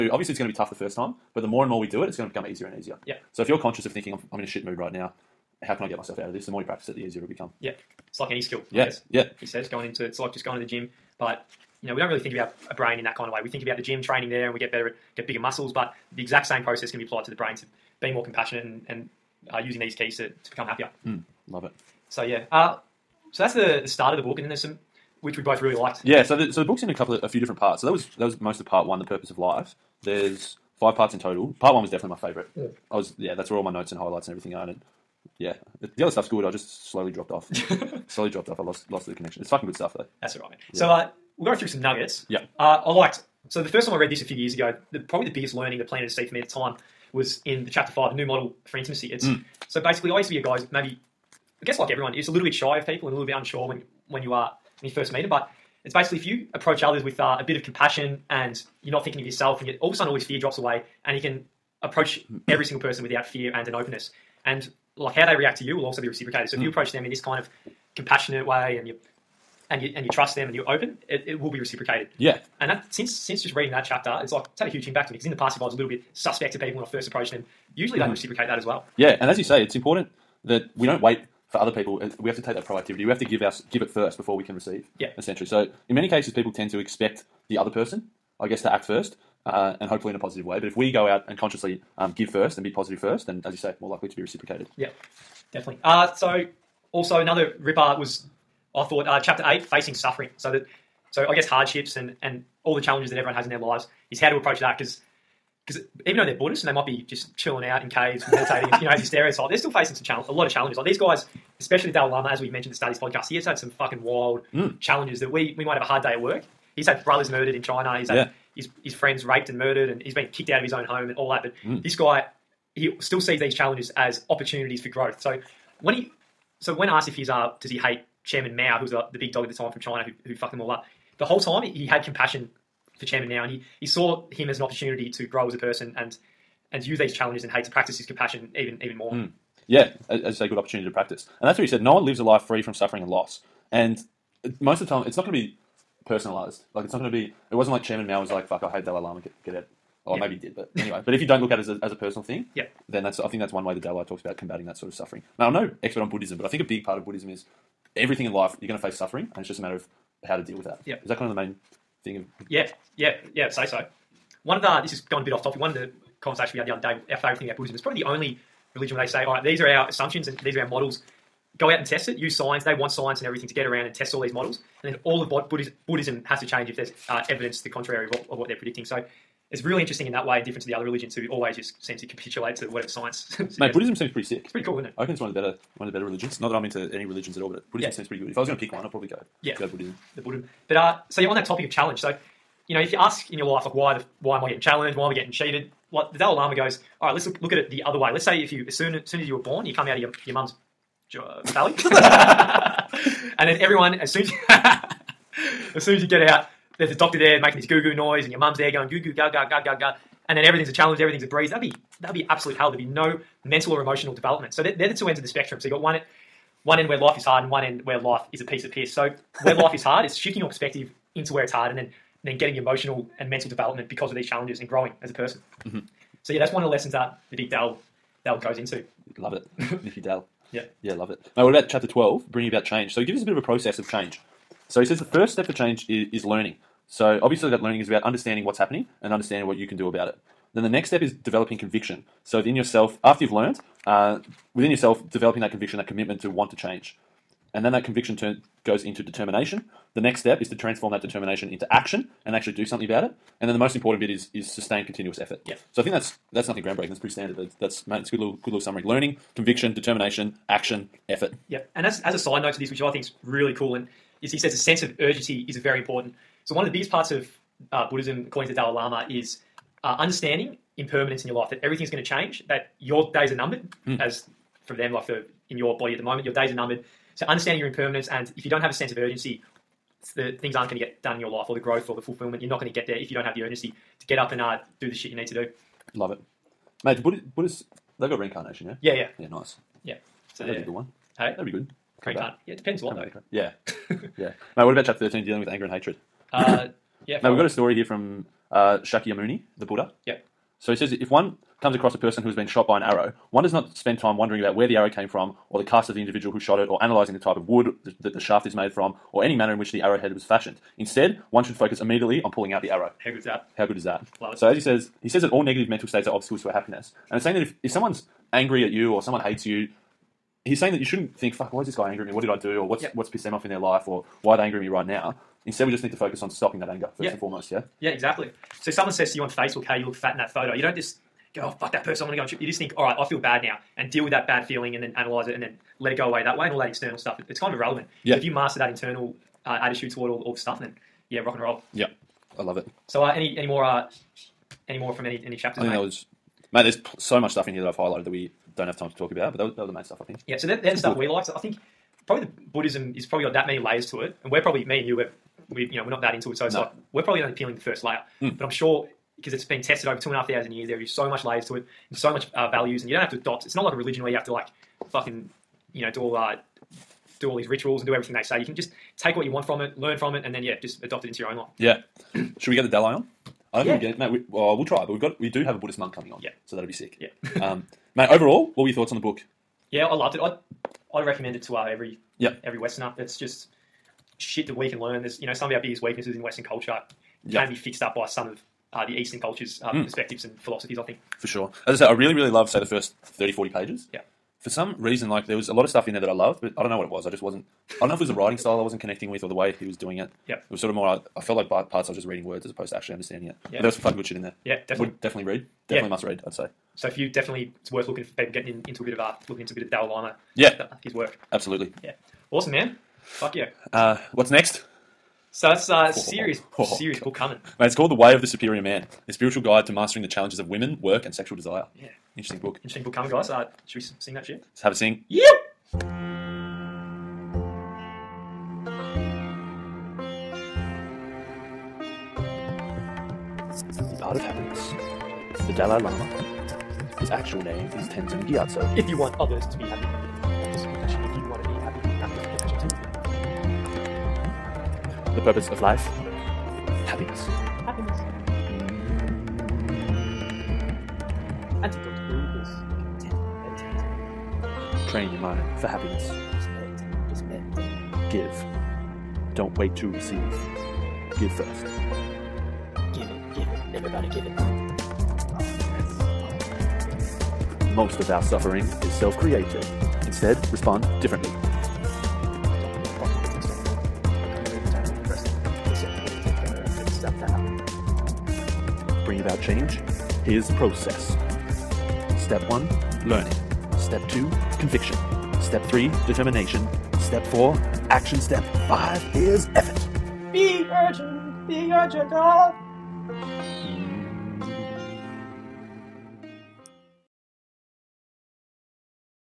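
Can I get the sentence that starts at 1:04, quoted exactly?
And like how they react to you will also be reciprocated.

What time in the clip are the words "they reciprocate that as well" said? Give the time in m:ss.
1:18.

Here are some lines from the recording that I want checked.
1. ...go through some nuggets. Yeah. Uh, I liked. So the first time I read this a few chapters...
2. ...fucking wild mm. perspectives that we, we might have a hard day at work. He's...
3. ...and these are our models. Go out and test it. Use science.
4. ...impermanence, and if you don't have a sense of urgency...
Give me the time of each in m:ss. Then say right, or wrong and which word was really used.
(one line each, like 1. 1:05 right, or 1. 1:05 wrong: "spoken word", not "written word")
1. 0:41 wrong: "years", not "chapters"
2. 1:53 wrong: "challenges", not "perspectives"
3. 2:50 right
4. 4:37 right.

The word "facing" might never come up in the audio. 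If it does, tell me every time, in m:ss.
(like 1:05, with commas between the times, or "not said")
1:39, 1:49.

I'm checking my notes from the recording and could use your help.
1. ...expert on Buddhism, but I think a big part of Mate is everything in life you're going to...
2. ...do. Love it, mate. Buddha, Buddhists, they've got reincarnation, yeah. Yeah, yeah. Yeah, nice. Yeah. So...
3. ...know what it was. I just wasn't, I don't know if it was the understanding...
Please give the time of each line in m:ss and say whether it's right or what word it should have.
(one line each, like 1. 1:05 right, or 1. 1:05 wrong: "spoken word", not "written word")
1. 2:35 wrong: "Buddhism", not "Mate"
2. 4:45 right
3. 6:36 wrong: "writing", not "understanding".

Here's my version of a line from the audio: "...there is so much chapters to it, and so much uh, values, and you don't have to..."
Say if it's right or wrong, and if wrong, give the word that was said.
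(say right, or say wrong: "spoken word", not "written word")
wrong: "layers", not "chapters".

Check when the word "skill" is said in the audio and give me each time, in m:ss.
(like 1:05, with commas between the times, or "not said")
0:08.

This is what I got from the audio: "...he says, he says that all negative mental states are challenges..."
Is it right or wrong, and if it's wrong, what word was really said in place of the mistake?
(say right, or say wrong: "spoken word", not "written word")
wrong: "obstacles", not "challenges".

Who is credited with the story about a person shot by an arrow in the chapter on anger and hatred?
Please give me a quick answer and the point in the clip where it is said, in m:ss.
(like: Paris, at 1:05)
Shakyamuni, at 4:58.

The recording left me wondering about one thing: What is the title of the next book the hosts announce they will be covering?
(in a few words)
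The Way of the Superior Man.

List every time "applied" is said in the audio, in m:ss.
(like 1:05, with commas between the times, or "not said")
0:17.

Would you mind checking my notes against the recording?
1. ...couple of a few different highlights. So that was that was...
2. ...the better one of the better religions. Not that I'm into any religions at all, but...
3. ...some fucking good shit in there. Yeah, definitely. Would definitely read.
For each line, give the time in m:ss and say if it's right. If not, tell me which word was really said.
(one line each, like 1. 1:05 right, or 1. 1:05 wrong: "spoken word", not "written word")
1. 0:26 wrong: "parts", not "highlights"
2. 3:05 right
3. 6:43 right.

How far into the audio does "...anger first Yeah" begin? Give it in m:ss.
5:26.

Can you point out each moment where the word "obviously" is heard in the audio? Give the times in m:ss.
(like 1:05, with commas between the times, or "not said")
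0:00, 3:57.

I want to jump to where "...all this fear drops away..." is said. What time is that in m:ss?
1:00.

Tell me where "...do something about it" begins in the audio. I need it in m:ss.
4:12.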